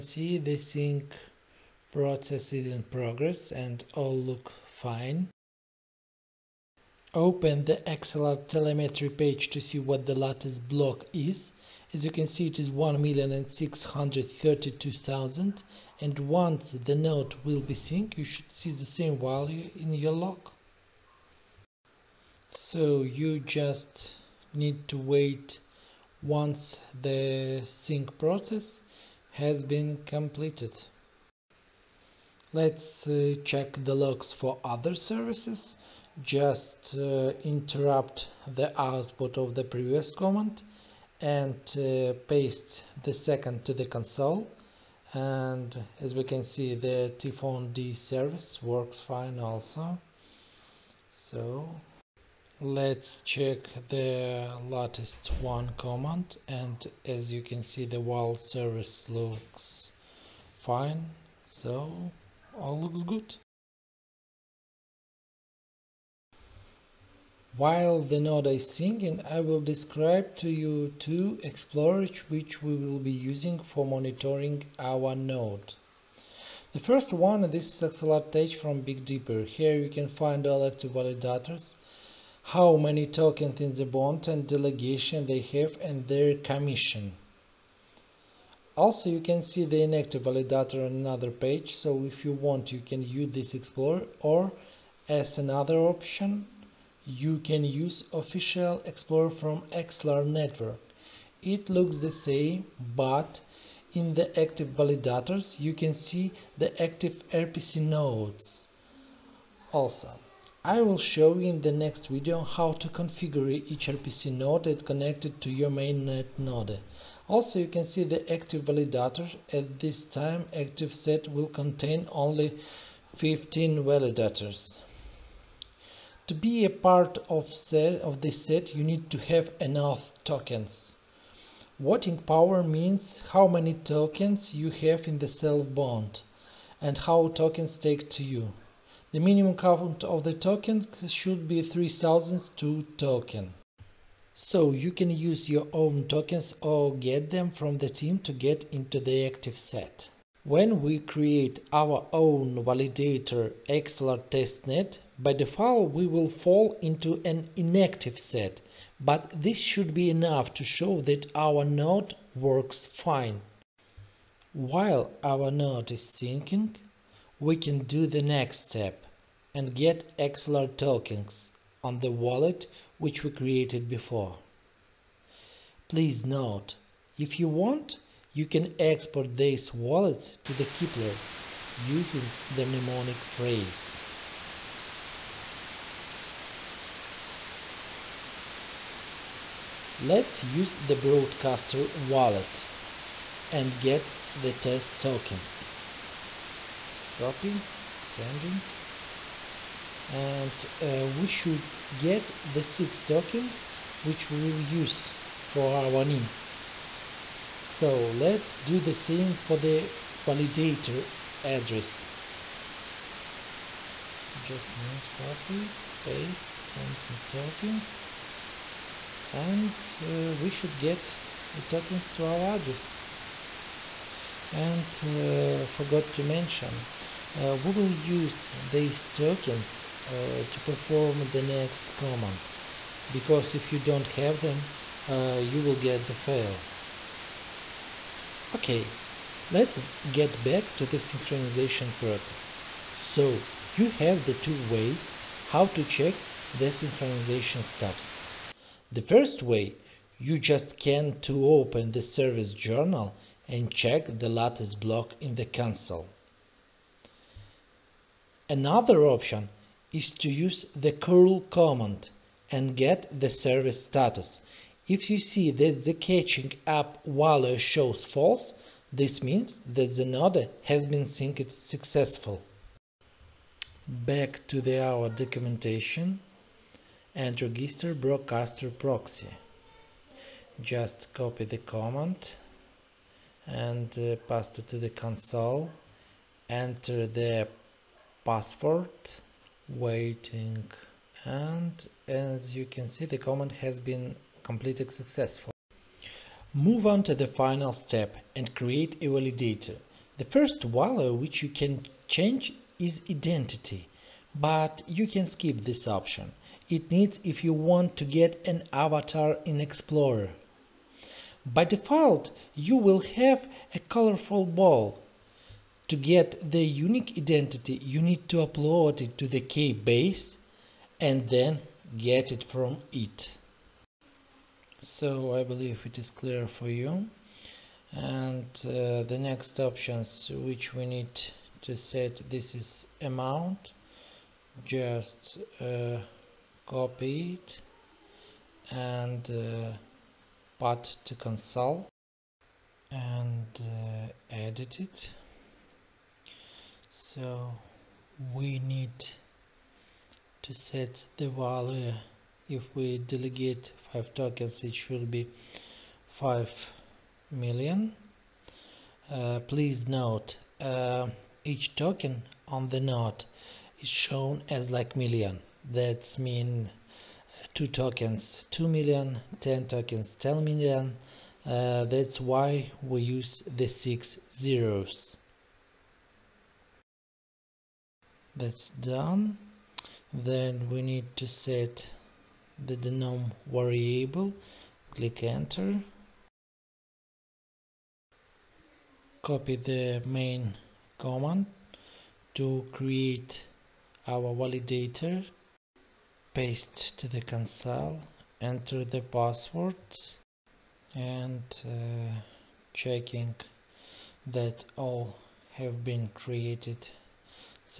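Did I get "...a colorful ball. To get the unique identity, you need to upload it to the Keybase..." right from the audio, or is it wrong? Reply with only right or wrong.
right.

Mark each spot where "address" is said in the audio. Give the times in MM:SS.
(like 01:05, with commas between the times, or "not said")
03:31, 03:42.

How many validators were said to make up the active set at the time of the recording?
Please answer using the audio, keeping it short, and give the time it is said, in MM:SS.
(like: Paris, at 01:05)
15, at 02:03.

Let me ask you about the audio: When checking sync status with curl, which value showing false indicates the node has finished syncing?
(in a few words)
catching up.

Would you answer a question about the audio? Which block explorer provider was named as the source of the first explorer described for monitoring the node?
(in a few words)
Big Dipper.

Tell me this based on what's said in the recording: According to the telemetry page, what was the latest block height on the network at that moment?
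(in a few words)
1,632,000.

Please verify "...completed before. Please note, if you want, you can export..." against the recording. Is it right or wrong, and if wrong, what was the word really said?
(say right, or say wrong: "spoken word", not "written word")
wrong: "created", not "completed".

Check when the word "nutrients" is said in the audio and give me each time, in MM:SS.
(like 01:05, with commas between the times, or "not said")
not said.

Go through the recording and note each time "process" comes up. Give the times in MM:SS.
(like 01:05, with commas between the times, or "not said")
00:01, 00:28, 04:01.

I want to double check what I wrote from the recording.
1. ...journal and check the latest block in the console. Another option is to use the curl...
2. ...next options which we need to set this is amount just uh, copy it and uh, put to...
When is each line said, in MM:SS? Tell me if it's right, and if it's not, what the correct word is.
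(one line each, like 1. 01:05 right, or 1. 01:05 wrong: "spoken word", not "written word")
1. 04:12 right
2. 05:29 right.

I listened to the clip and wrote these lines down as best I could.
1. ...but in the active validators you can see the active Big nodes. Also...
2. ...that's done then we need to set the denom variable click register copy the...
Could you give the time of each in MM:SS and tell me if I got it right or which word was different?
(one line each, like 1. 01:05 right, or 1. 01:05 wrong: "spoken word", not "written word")
1. 01:42 wrong: "RPC", not "Big"
2. 06:18 wrong: "enter", not "register".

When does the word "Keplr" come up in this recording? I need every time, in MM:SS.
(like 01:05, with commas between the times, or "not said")
03:00.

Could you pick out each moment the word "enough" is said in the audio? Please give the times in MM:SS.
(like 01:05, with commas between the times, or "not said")
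02:09, 02:40.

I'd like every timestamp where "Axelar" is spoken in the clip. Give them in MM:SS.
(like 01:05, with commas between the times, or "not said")
00:07, 01:39, 02:33, 02:50.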